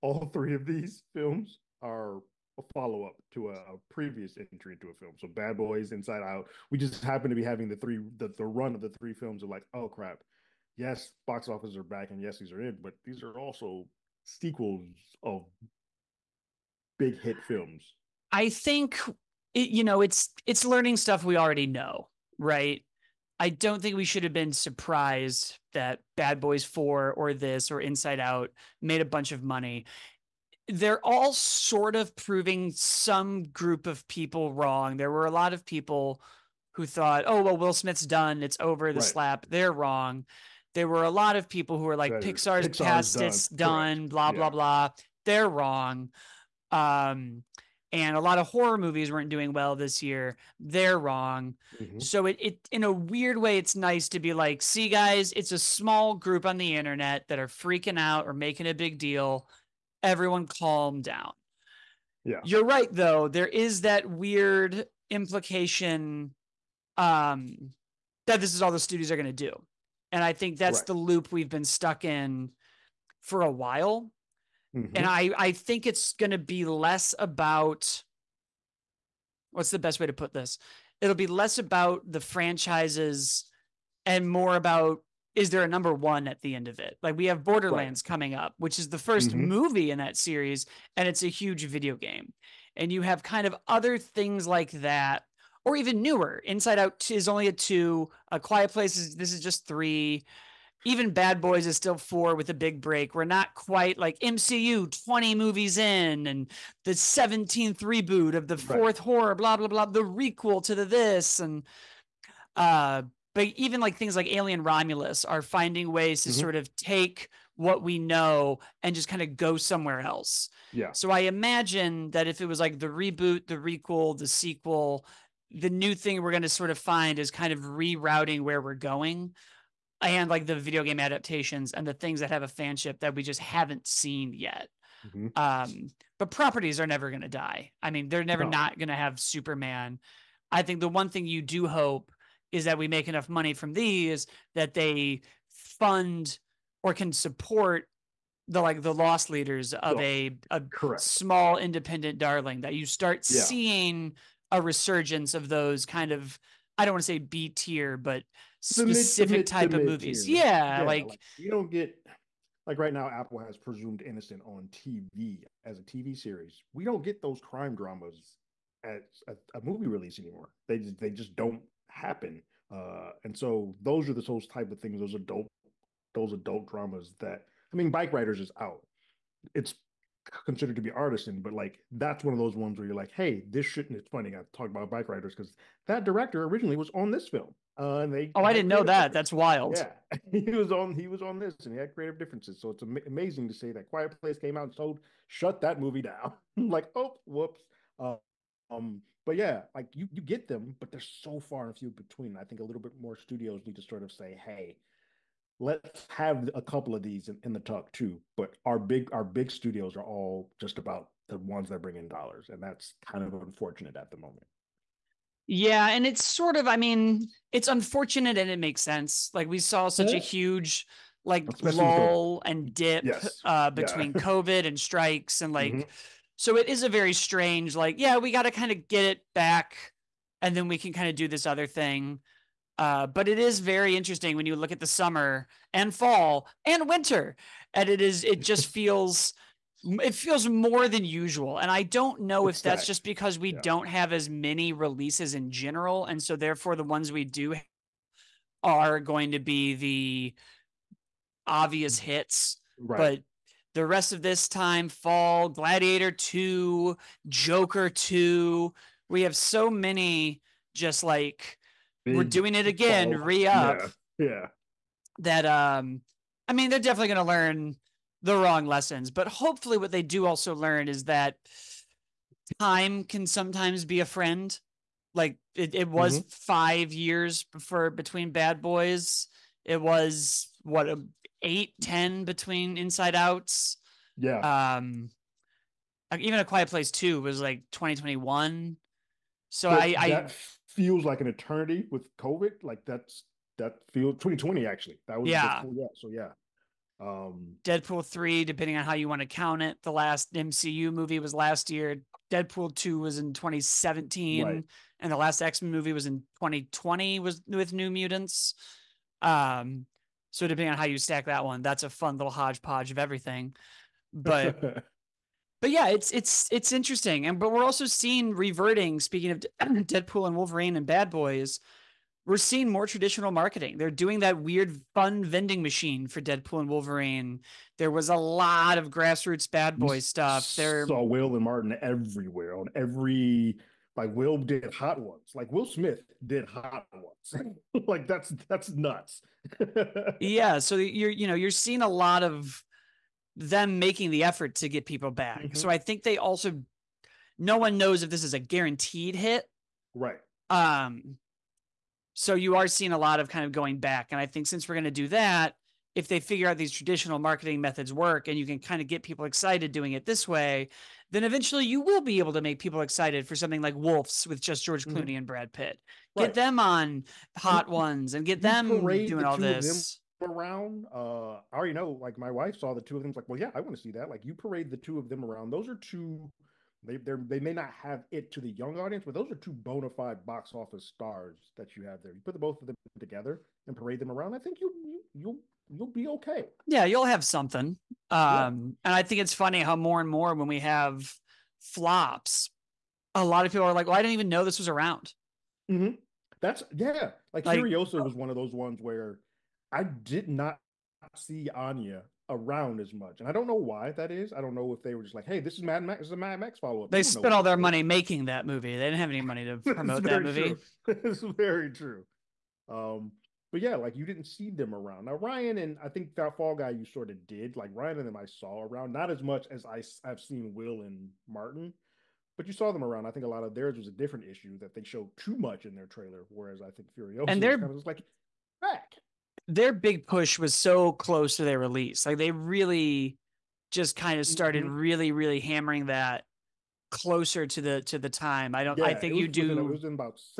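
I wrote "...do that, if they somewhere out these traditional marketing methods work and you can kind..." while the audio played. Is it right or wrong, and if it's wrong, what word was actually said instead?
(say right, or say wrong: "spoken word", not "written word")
wrong: "figure", not "somewhere".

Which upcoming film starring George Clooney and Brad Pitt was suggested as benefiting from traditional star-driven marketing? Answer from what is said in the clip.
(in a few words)
Wolves.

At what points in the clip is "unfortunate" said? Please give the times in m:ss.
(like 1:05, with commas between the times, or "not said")
3:33, 3:37.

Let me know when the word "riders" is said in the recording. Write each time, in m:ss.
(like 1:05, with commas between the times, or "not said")
2:58, 3:05.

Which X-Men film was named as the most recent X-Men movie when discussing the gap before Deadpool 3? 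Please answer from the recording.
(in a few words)
New Mutants.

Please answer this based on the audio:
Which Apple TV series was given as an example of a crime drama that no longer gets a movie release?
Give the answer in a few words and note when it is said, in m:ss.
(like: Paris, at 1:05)
Presumed Innocent, at 2:43.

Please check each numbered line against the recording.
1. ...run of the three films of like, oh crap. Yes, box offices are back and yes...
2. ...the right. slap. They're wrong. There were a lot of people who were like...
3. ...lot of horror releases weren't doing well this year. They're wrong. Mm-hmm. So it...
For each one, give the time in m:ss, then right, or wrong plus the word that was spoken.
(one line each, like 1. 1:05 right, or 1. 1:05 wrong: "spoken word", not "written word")
1. 0:08 right
2. 0:38 right
3. 0:48 wrong: "movies", not "releases".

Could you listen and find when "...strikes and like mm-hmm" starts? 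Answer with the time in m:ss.
3:44.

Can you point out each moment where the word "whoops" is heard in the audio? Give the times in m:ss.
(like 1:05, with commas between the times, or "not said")
3:17.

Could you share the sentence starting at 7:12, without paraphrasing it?
Like they really just kind of started mm-hmm.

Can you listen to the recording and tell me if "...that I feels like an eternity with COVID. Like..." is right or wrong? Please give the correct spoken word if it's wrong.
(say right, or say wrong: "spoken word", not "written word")
right.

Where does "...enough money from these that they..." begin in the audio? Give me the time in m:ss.
2:23.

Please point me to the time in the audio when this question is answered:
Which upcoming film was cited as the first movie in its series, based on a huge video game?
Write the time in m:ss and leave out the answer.
1:27.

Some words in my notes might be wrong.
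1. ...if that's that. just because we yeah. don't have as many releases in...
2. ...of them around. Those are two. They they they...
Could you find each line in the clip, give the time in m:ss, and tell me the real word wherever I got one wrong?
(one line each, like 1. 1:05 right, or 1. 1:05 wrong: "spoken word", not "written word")
1. 4:02 right
2. 6:14 right.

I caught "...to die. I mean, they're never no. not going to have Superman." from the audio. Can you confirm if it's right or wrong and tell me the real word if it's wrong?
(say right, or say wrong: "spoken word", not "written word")
right.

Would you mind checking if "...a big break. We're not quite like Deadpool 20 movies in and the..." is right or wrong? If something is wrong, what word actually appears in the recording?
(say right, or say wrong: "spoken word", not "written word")
wrong: "MCU", not "Deadpool".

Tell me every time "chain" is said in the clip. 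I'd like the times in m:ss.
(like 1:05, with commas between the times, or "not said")
not said.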